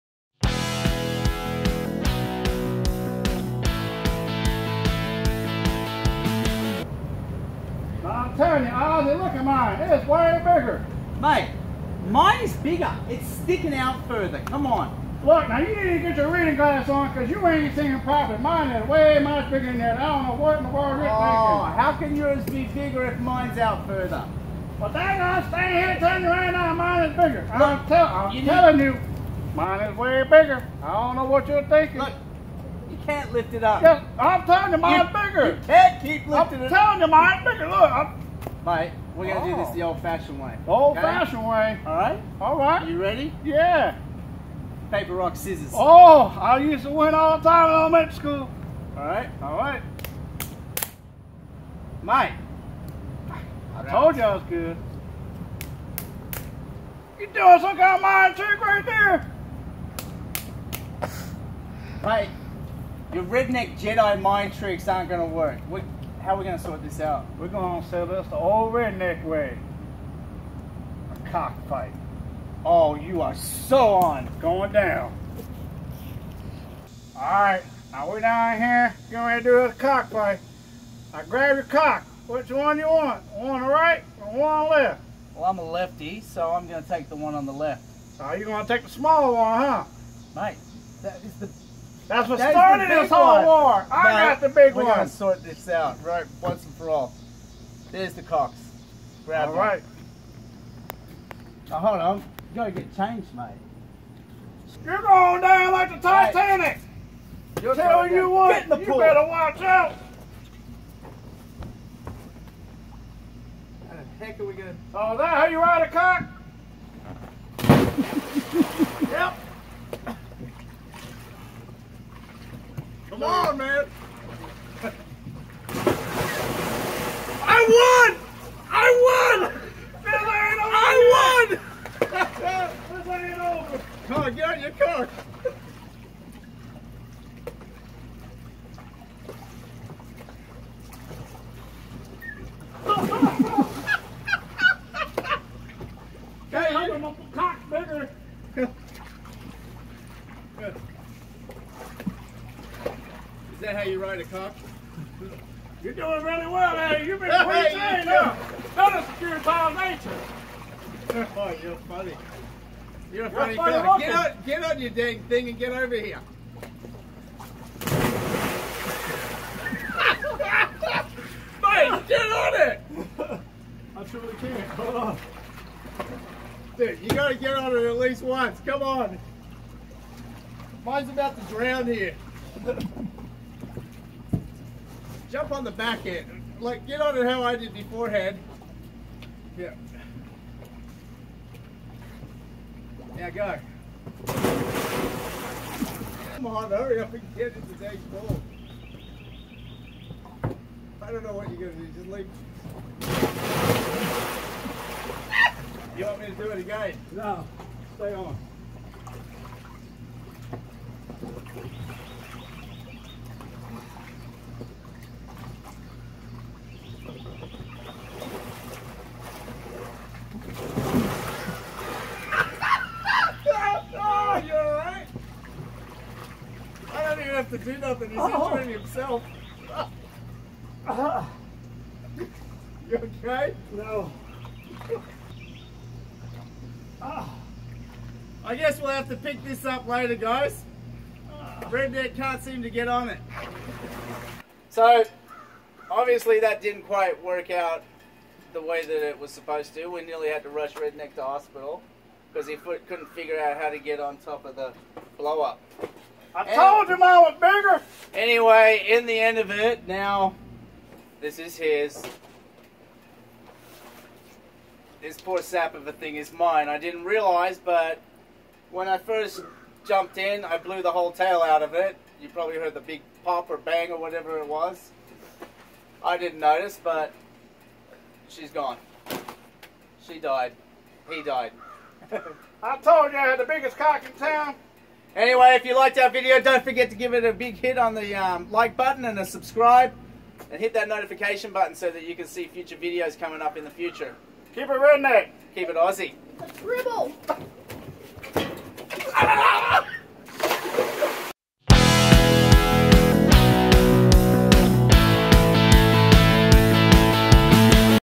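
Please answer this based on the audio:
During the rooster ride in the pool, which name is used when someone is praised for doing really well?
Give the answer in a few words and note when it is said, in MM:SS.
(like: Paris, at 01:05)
Eddie, at 02:36.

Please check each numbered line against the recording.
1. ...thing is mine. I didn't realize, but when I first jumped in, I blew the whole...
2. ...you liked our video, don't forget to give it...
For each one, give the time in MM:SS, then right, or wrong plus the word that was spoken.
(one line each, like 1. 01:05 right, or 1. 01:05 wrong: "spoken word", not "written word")
1. 04:25 right
2. 04:45 right.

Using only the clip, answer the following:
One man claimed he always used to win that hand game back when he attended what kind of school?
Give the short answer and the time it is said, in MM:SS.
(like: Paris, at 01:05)
Elementary school, at 00:47.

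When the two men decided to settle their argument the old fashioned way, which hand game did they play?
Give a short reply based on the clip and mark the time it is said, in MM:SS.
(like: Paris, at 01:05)
Paper, rock, scissors, at 00:44.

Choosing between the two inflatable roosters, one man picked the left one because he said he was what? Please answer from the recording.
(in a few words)
A lefty.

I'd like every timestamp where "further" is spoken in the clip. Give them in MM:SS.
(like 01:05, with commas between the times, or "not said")
00:14, 00:23.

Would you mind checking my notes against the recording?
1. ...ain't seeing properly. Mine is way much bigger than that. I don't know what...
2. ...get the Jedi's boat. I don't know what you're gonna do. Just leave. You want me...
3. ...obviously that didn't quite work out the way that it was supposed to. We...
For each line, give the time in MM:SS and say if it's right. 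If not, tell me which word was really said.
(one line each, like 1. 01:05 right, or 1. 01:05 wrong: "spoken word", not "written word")
1. 00:17 right
2. 03:17 wrong: "Today", not "Jedi"
3. 04:05 right.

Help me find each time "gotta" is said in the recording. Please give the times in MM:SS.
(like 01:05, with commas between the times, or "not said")
01:42, 02:57.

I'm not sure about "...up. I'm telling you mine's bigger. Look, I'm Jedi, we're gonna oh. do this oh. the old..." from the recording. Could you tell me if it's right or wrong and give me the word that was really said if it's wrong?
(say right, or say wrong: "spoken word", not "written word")
wrong: "Alright", not "Jedi".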